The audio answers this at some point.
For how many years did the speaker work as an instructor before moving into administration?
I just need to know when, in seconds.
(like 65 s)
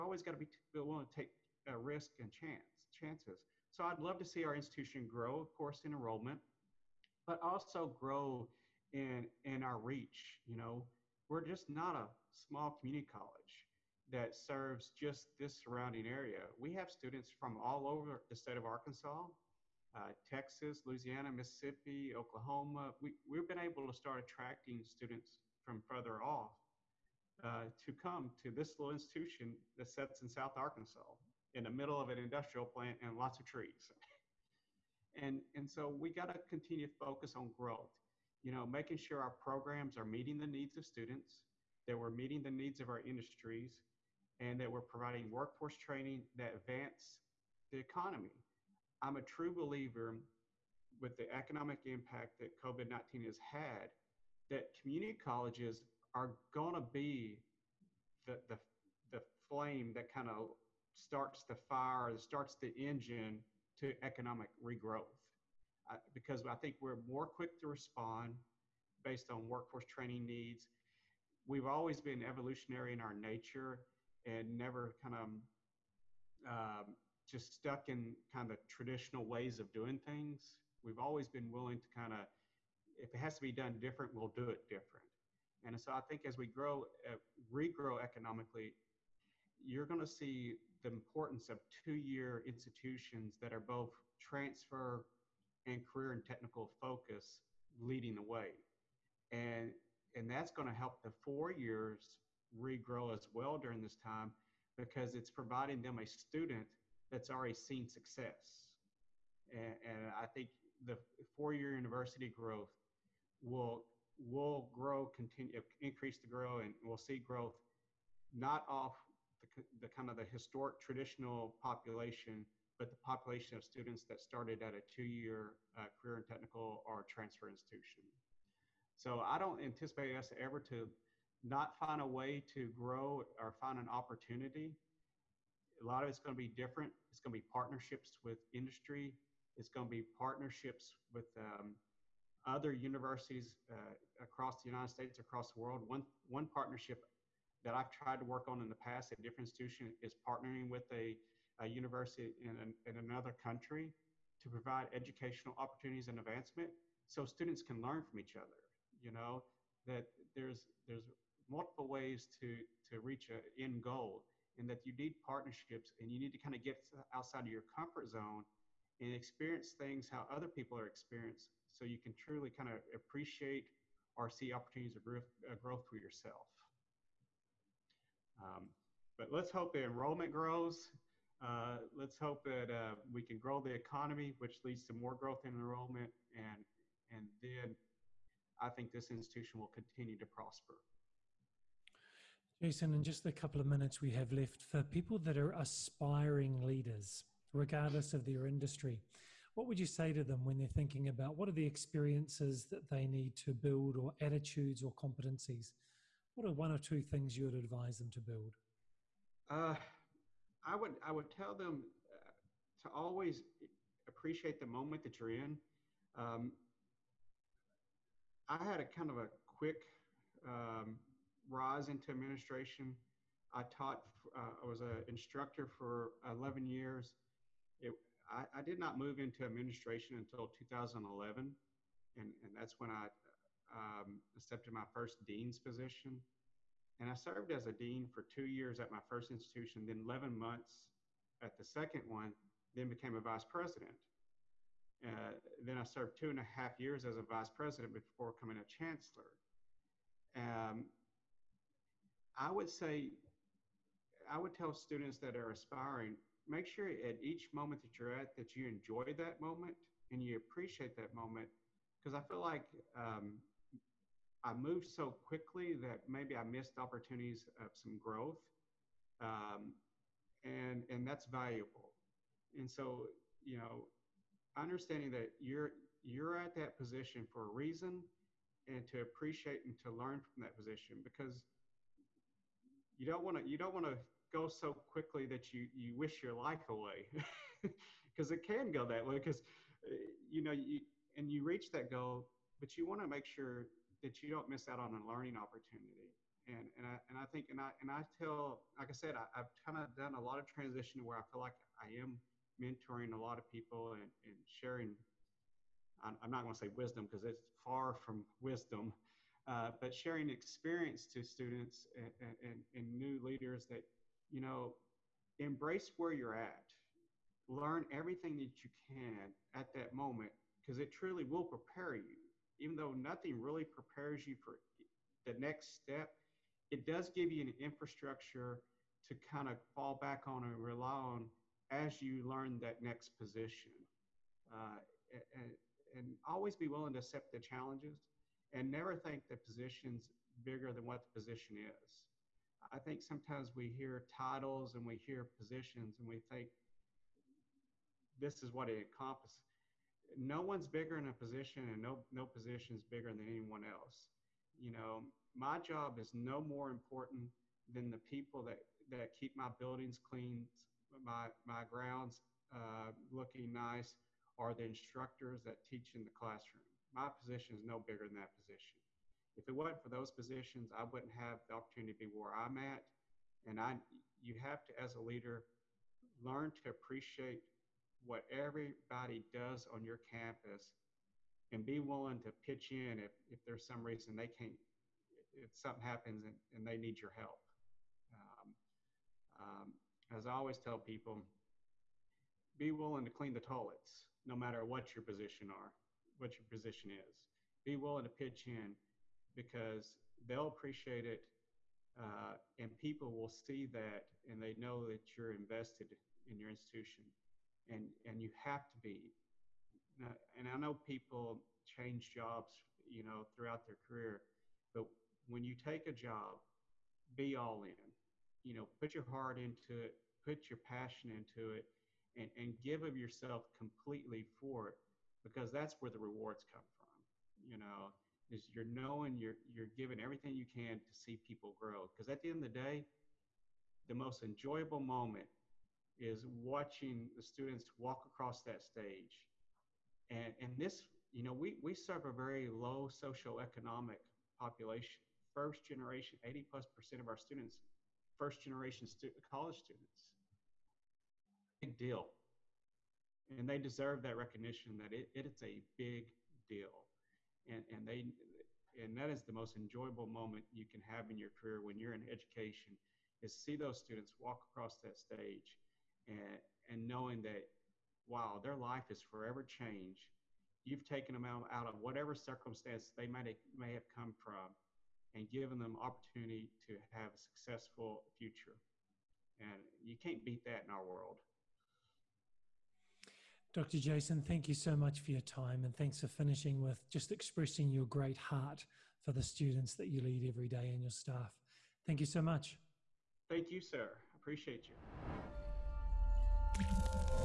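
226 s.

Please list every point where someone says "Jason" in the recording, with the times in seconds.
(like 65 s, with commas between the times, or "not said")
192 s, 483 s.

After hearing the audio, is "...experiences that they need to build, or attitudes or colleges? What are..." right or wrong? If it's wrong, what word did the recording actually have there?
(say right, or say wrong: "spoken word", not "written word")
wrong: "competencies", not "colleges".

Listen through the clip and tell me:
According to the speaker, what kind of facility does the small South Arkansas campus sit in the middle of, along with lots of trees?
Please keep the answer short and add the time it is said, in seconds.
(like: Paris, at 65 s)
an industrial plant, at 32 s.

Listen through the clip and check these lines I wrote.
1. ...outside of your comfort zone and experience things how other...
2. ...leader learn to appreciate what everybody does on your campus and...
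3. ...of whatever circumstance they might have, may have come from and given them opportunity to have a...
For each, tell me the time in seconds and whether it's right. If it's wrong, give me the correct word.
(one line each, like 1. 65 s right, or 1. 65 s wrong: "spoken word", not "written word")
1. 167 s right
2. 375 s right
3. 471 s right.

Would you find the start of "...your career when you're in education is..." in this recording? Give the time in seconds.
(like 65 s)
461 s.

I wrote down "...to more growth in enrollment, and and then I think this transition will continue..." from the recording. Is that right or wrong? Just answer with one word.
wrong.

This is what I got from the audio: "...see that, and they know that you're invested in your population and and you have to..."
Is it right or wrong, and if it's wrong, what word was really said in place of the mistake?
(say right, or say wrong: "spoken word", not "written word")
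wrong: "institution", not "population".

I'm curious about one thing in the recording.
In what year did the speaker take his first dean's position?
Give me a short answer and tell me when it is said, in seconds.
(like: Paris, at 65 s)
2011, at 230 s.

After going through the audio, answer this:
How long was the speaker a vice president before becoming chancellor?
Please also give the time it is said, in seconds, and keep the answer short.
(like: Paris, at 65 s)
two and a half years, at 246 s.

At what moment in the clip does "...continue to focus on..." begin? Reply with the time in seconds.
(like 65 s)
36 s.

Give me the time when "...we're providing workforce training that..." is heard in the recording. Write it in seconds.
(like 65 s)
44 s.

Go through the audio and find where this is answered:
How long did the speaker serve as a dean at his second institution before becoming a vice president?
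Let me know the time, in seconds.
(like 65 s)
240 s.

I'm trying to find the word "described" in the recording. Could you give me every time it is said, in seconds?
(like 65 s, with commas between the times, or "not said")
not said.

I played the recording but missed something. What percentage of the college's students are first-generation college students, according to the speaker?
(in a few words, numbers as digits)
80 plus percent.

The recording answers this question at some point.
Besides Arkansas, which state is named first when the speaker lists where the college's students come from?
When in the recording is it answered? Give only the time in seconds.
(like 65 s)
20 s.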